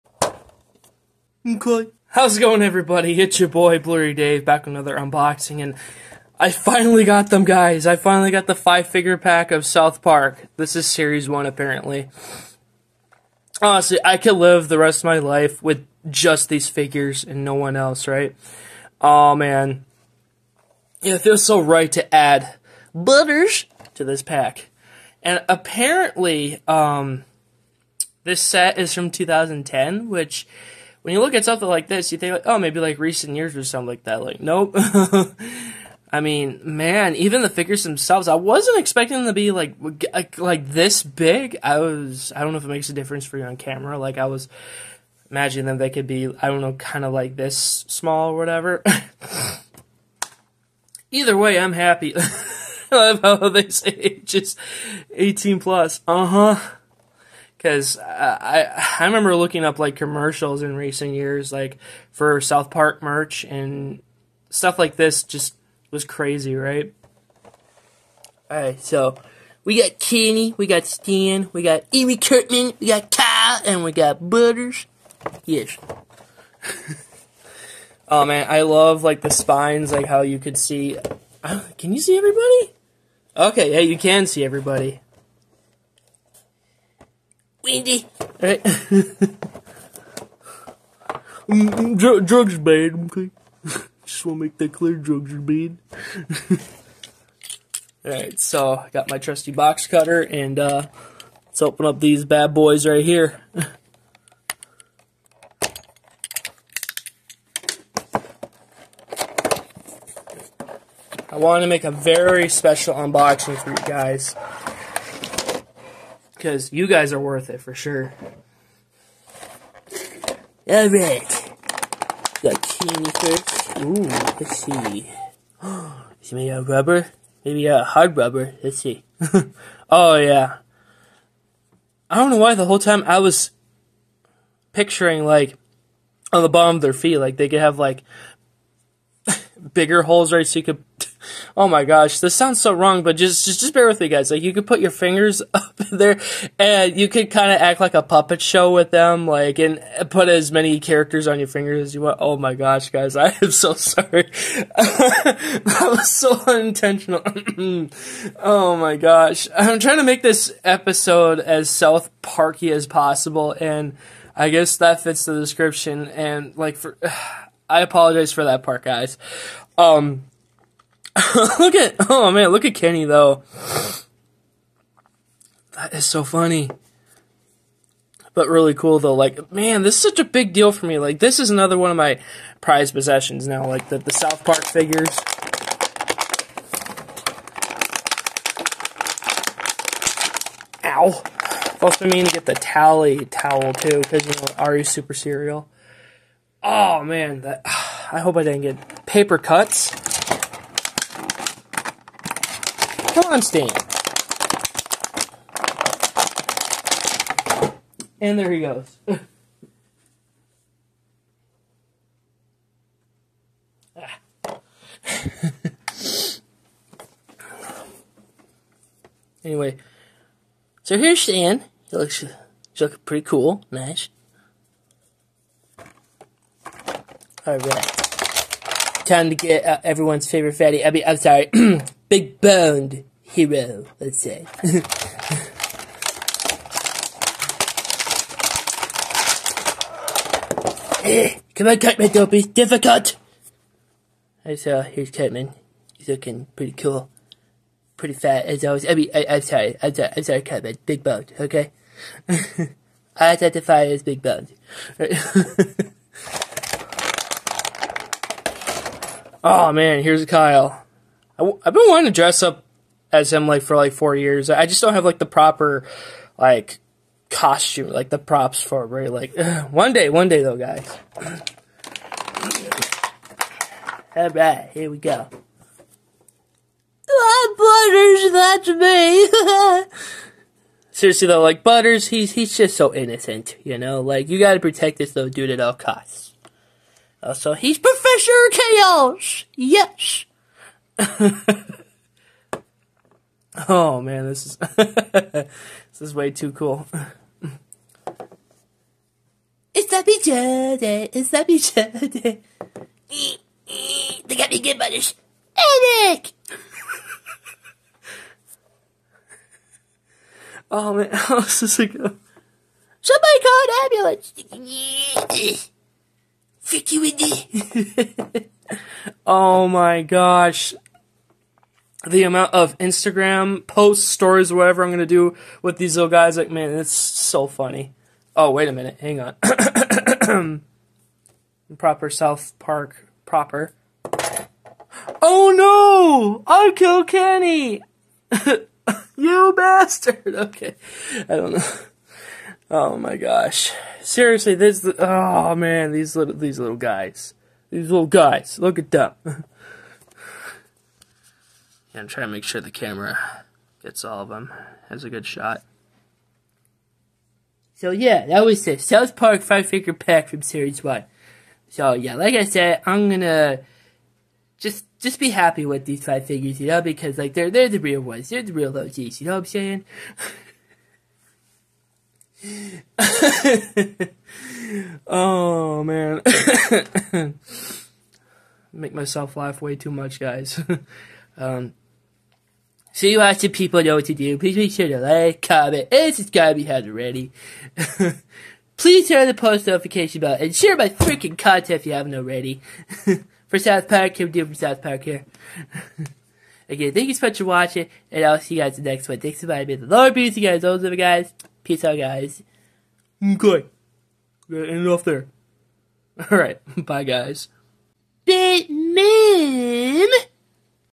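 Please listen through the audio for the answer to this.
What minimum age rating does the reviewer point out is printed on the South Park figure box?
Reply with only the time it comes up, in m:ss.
0:55.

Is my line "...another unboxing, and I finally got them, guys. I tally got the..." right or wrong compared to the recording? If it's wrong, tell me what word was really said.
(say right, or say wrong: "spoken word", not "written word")
wrong: "finally", not "tally".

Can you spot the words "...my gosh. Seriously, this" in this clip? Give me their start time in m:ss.
5:42.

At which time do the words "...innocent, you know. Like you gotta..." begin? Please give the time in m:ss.
4:42.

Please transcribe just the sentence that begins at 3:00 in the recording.
Like, this is another one of my prized possessions now, like the, the South Park figures.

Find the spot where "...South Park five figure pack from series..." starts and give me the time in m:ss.
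5:58.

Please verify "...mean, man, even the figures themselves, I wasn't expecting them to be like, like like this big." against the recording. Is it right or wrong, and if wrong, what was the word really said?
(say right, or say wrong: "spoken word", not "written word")
right.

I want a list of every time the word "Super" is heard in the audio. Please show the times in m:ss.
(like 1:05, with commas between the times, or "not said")
3:14.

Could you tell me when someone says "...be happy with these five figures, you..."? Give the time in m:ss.
6:05.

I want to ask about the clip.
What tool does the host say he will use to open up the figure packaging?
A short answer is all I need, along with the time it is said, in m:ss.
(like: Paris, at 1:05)
box cutter, at 1:39.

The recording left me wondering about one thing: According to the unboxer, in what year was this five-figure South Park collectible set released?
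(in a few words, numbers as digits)
2010.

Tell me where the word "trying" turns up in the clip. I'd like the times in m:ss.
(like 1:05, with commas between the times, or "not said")
2:39, 5:52.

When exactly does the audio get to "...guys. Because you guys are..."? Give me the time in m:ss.
1:53.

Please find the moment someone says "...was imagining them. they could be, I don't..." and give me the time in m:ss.
0:44.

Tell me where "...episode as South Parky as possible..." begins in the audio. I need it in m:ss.
2:40.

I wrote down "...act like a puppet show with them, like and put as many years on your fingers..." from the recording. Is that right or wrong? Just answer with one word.
wrong.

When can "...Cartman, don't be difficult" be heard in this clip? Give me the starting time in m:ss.
4:01.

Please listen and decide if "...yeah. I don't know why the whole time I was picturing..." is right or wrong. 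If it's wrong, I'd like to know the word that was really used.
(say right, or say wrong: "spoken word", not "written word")
right.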